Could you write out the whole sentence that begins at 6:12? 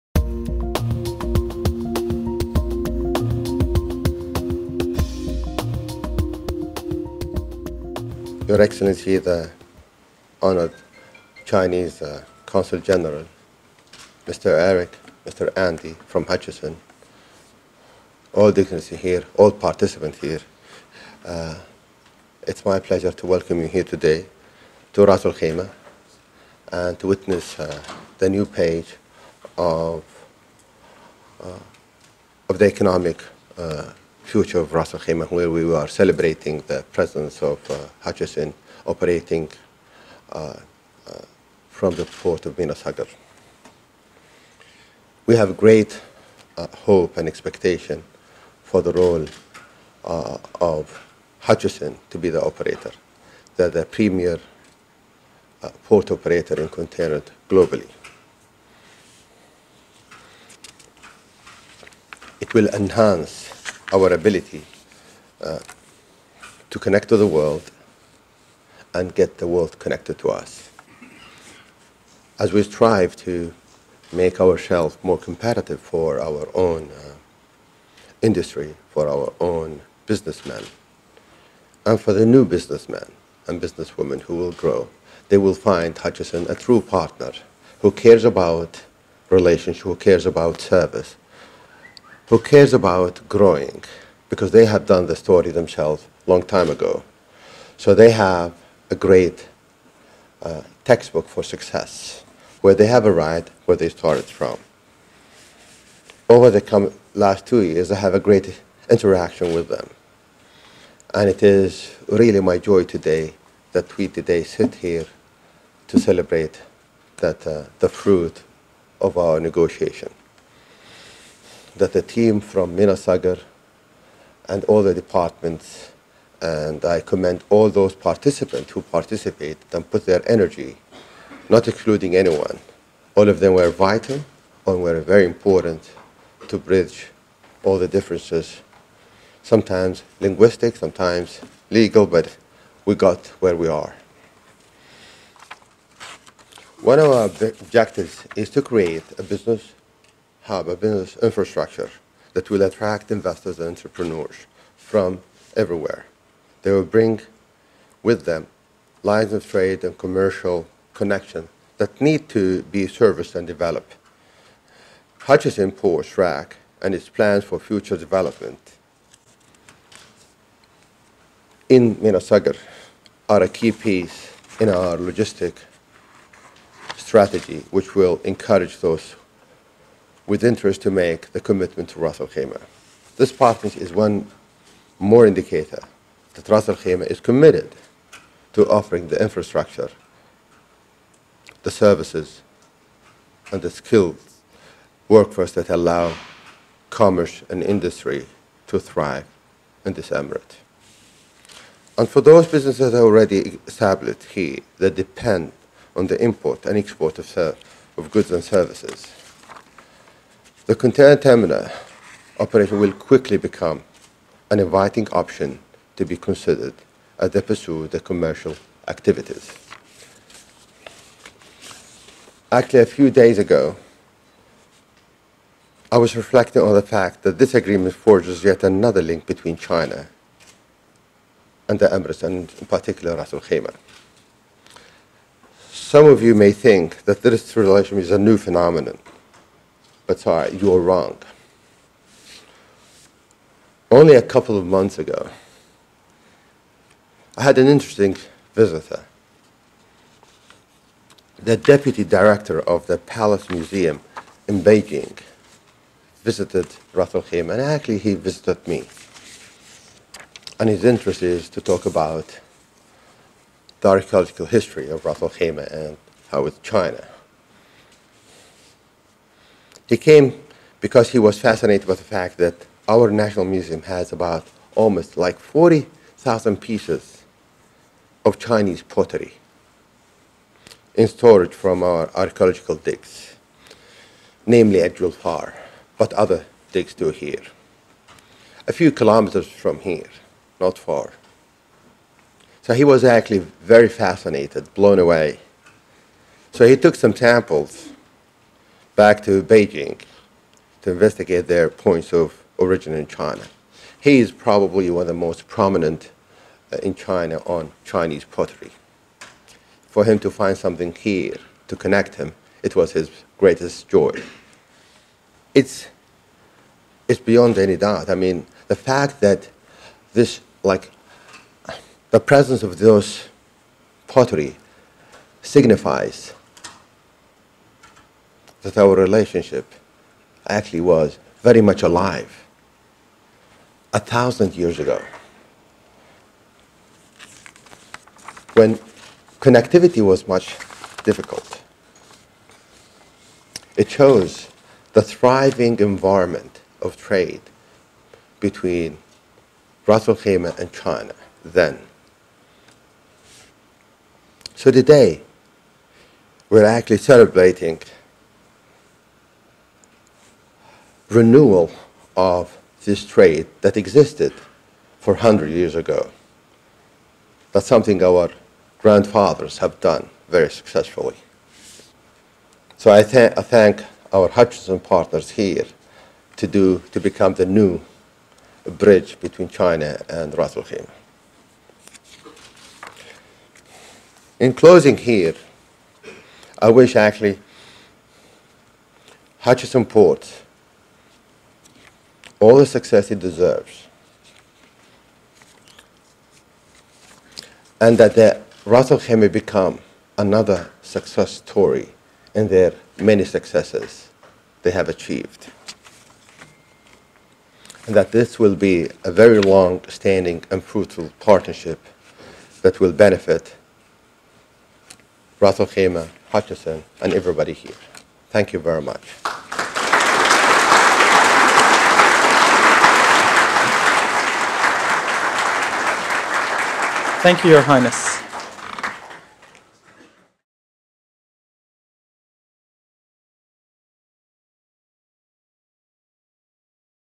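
So I, th I thank our Hutchison partners here to, do, to become the new bridge between China and Ras Al Khaimah.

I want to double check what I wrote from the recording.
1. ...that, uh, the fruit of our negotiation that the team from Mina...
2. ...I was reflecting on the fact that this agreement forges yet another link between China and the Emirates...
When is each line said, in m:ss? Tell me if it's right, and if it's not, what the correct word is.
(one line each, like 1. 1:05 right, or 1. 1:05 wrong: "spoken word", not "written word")
1. 1:57 right
2. 3:45 right.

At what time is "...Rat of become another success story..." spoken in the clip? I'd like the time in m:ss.
6:38.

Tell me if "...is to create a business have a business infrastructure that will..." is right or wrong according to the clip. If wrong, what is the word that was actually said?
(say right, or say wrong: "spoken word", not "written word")
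right.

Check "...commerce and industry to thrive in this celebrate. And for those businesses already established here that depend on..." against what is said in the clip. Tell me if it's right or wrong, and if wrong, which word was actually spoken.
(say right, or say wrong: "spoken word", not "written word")
wrong: "emirate", not "celebrate".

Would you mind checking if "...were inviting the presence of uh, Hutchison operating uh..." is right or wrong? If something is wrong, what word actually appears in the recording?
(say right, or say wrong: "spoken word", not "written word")
wrong: "celebrating", not "inviting".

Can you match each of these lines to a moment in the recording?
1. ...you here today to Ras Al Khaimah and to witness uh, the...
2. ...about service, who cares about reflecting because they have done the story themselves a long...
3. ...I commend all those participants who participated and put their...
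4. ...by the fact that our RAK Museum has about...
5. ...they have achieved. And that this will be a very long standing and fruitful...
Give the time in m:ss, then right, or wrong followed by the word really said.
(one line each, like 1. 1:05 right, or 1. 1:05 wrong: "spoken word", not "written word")
1. 0:23 right
2. 1:30 wrong: "growing", not "reflecting"
3. 2:06 right
4. 4:31 wrong: "National", not "RAK"
5. 6:44 right.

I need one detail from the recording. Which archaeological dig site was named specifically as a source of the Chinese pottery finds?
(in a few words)
Julfar.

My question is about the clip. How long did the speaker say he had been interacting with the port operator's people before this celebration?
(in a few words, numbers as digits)
2 years.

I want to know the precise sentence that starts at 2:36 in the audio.
They will bring with them lines of trade and commercial connection that need to be serviced and developed.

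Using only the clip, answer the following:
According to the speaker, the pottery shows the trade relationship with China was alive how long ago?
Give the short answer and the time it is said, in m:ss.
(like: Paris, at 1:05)
1,000 years ago, at 5:33.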